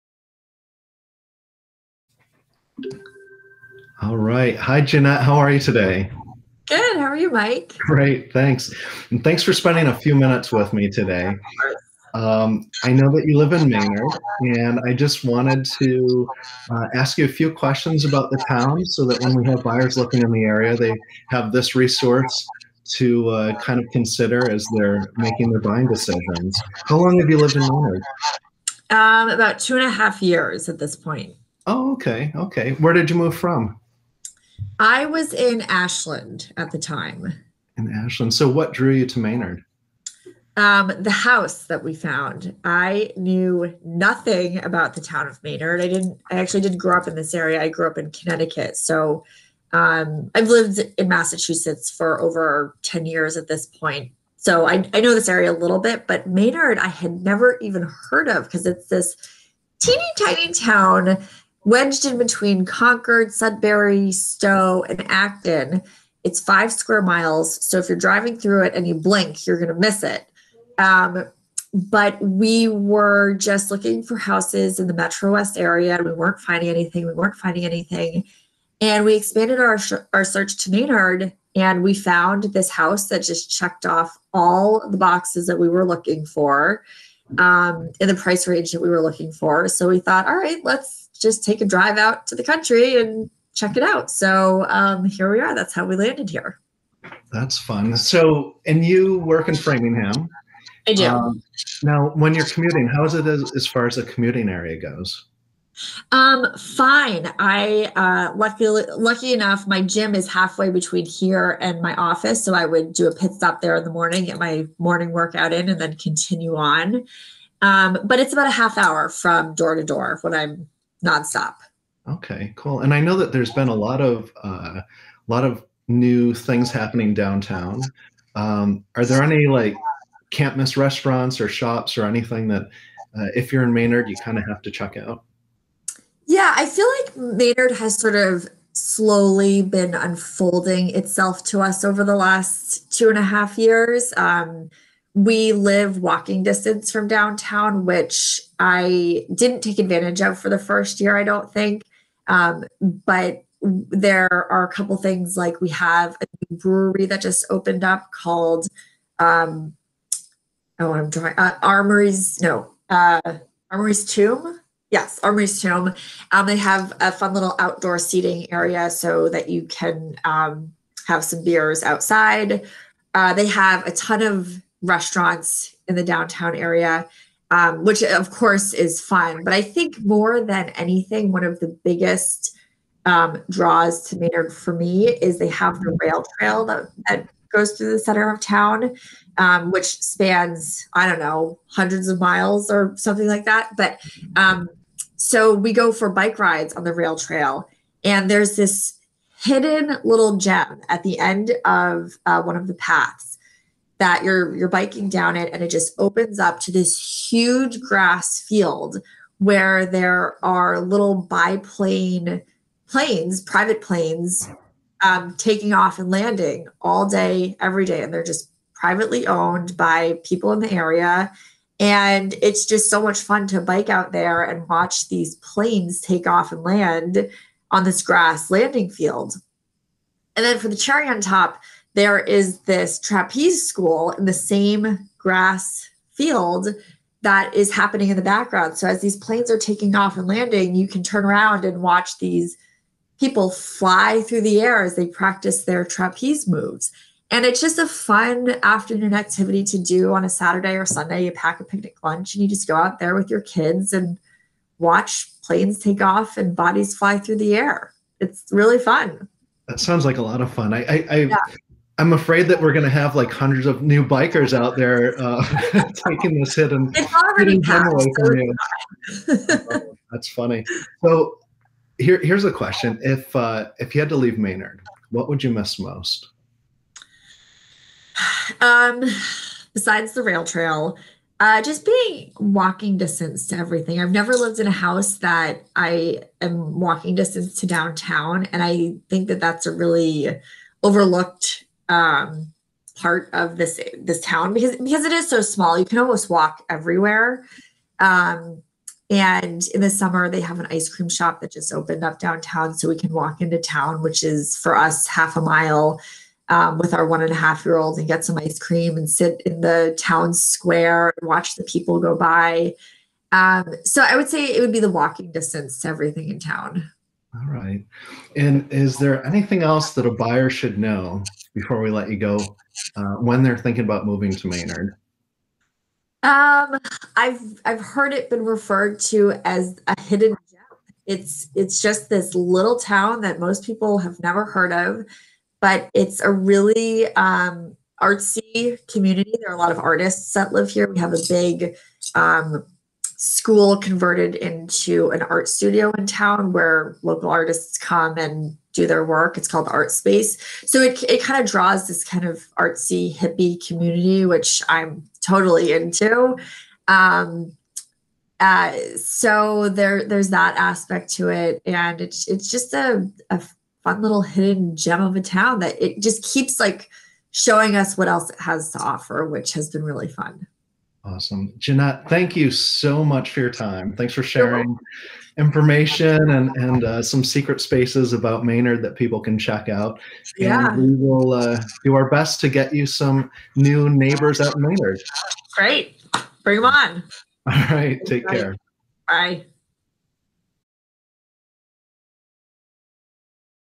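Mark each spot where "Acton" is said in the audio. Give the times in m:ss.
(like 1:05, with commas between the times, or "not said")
1:05.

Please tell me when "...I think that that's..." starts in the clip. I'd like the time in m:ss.
4:48.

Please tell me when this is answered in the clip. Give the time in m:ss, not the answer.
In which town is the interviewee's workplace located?
1:39.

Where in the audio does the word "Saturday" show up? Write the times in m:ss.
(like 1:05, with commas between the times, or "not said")
4:10.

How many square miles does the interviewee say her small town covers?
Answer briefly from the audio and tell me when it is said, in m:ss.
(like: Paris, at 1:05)
5, at 1:06.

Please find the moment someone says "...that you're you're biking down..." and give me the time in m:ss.
3:24.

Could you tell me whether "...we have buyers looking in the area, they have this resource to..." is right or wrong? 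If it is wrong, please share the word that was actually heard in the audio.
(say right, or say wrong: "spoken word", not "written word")
right.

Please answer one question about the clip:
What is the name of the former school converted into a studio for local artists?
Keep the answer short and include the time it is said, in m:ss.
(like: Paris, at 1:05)
Art Space, at 5:49.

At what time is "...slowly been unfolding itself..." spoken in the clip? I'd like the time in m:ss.
2:18.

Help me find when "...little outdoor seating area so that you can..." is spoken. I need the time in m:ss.
2:47.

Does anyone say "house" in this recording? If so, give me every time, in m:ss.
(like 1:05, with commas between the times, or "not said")
0:41, 1:14, 1:22, 4:44.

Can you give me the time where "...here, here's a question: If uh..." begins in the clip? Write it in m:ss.
4:31.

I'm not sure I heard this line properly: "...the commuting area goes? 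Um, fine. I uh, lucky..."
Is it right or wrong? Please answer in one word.
right.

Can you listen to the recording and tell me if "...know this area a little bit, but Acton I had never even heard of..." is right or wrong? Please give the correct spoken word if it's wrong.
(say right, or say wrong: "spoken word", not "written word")
wrong: "Maynard", not "Acton".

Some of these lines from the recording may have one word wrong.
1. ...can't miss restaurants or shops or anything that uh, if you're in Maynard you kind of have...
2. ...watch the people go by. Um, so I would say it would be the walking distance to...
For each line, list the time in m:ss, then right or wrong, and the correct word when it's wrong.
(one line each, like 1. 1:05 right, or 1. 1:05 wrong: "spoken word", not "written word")
1. 2:10 right
2. 5:11 right.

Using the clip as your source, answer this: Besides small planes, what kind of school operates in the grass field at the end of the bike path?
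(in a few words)
trapeze school.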